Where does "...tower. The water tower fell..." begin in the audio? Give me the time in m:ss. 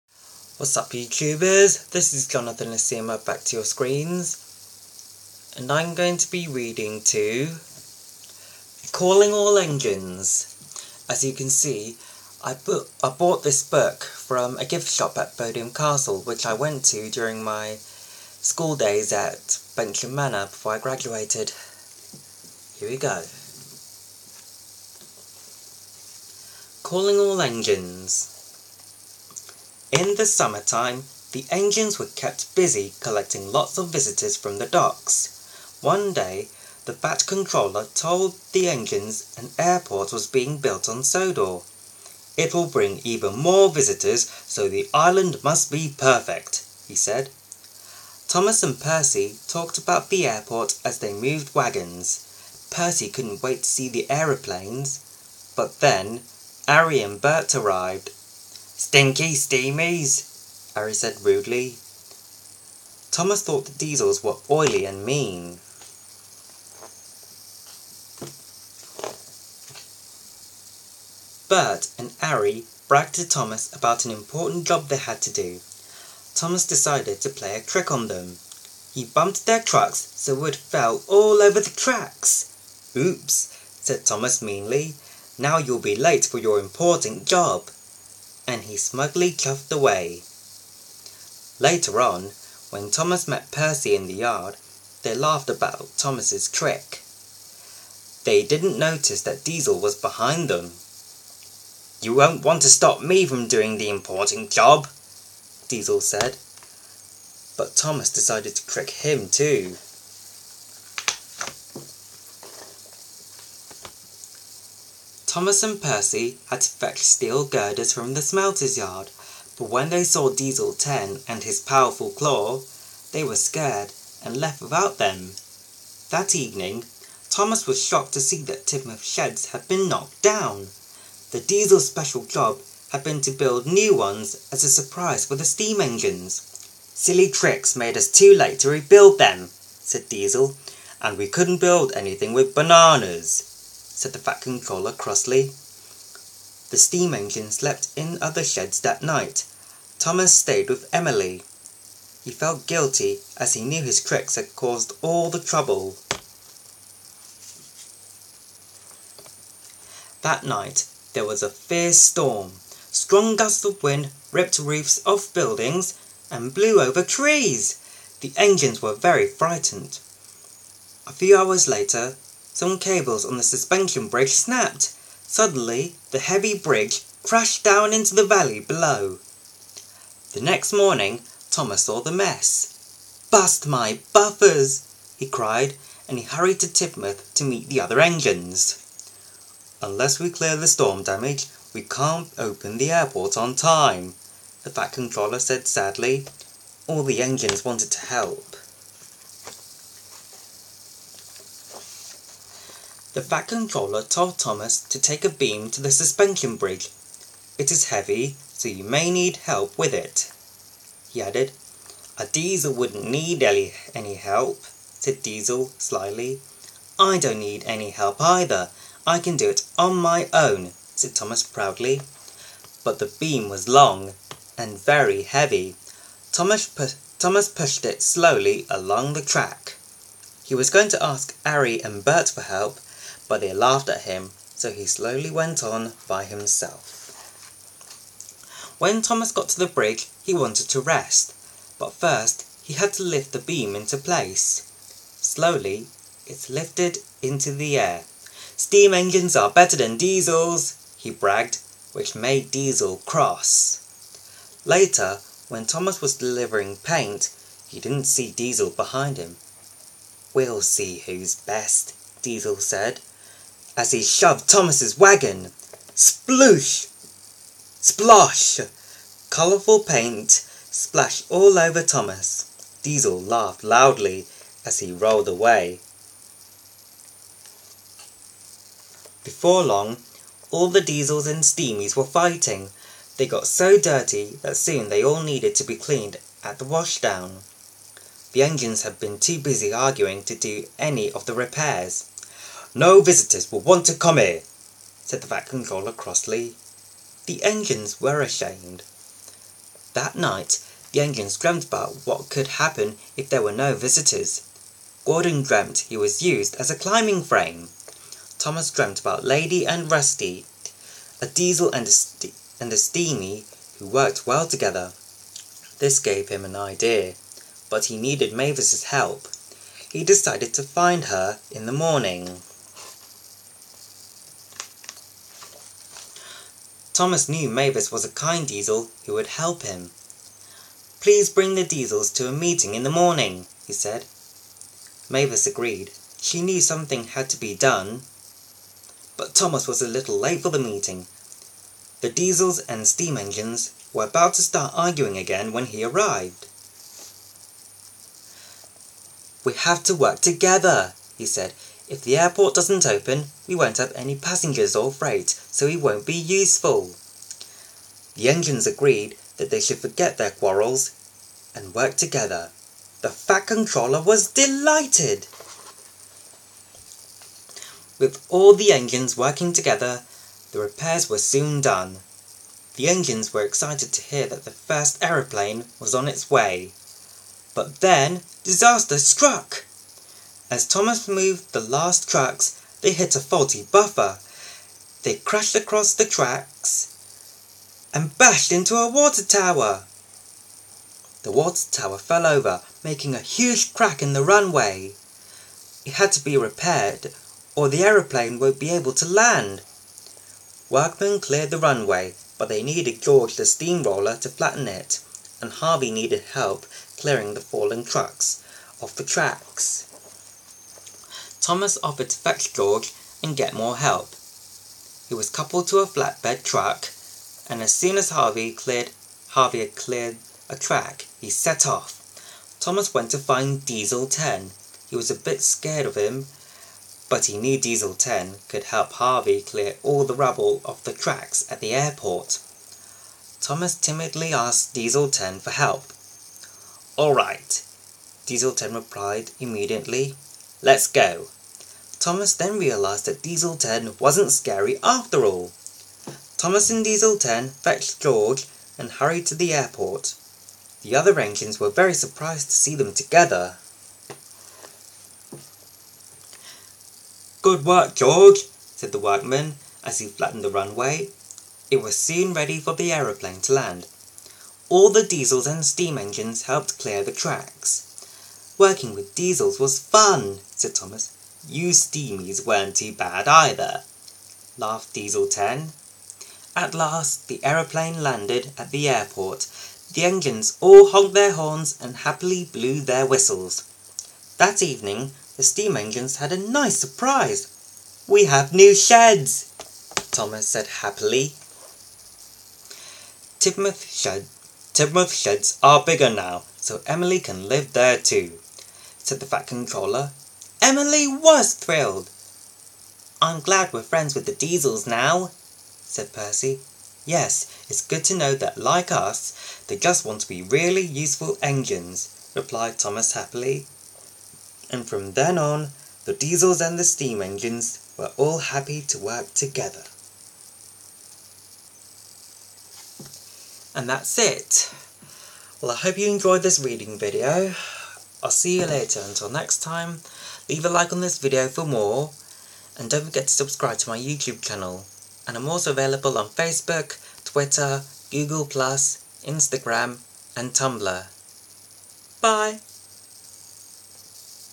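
6:29.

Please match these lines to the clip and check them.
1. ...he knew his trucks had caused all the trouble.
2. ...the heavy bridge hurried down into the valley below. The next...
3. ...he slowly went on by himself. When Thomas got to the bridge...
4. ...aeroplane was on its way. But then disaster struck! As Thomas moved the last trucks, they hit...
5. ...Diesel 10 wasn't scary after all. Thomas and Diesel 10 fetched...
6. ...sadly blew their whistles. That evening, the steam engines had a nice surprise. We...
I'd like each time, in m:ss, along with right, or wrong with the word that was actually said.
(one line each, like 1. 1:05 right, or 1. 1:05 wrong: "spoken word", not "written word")
1. 2:33 wrong: "tricks", not "trucks"
2. 2:56 wrong: "crashed", not "hurried"
3. 3:54 right
4. 6:15 right
5. 7:23 right
6. 8:02 wrong: "happily", not "sadly".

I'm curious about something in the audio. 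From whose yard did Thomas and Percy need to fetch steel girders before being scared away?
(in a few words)
The smelter's yard.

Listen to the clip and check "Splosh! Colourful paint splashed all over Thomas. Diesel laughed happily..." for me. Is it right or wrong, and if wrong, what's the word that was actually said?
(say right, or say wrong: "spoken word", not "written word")
wrong: "loudly", not "happily".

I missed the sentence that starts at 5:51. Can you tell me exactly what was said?
If the airport doesn't open, we won't have any passengers or freight, so we won't be useful.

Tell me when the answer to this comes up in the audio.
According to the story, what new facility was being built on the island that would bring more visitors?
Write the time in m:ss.
0:39.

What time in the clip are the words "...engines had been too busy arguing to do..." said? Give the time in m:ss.
4:48.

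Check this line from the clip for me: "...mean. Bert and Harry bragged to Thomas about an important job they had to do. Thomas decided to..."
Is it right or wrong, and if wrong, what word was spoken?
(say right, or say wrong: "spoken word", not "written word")
right.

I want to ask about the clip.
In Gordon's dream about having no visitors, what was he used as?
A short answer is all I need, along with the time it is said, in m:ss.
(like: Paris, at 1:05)
A climbing frame, at 5:06.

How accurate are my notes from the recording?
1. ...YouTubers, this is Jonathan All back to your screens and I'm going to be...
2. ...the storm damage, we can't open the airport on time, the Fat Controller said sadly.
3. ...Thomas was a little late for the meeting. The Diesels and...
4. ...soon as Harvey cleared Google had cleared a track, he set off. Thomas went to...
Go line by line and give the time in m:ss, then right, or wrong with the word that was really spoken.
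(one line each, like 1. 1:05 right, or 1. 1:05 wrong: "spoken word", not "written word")
1. 0:00 wrong: "Asiamah", not "All"
2. 3:10 right
3. 5:39 right
4. 6:57 wrong: "Harvey", not "Google".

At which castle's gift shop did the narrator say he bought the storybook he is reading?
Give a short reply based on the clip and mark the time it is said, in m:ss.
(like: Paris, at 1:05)
Bodiam Castle, at 0:15.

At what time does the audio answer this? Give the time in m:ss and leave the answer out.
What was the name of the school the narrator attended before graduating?
0:19.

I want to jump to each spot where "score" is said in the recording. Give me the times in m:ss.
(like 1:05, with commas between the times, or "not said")
not said.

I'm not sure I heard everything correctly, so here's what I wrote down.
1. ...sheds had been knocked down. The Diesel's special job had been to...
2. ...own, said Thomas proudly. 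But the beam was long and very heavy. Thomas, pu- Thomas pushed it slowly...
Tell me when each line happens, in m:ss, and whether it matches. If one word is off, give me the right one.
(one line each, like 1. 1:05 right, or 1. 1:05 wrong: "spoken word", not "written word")
1. 2:09 right
2. 3:40 right.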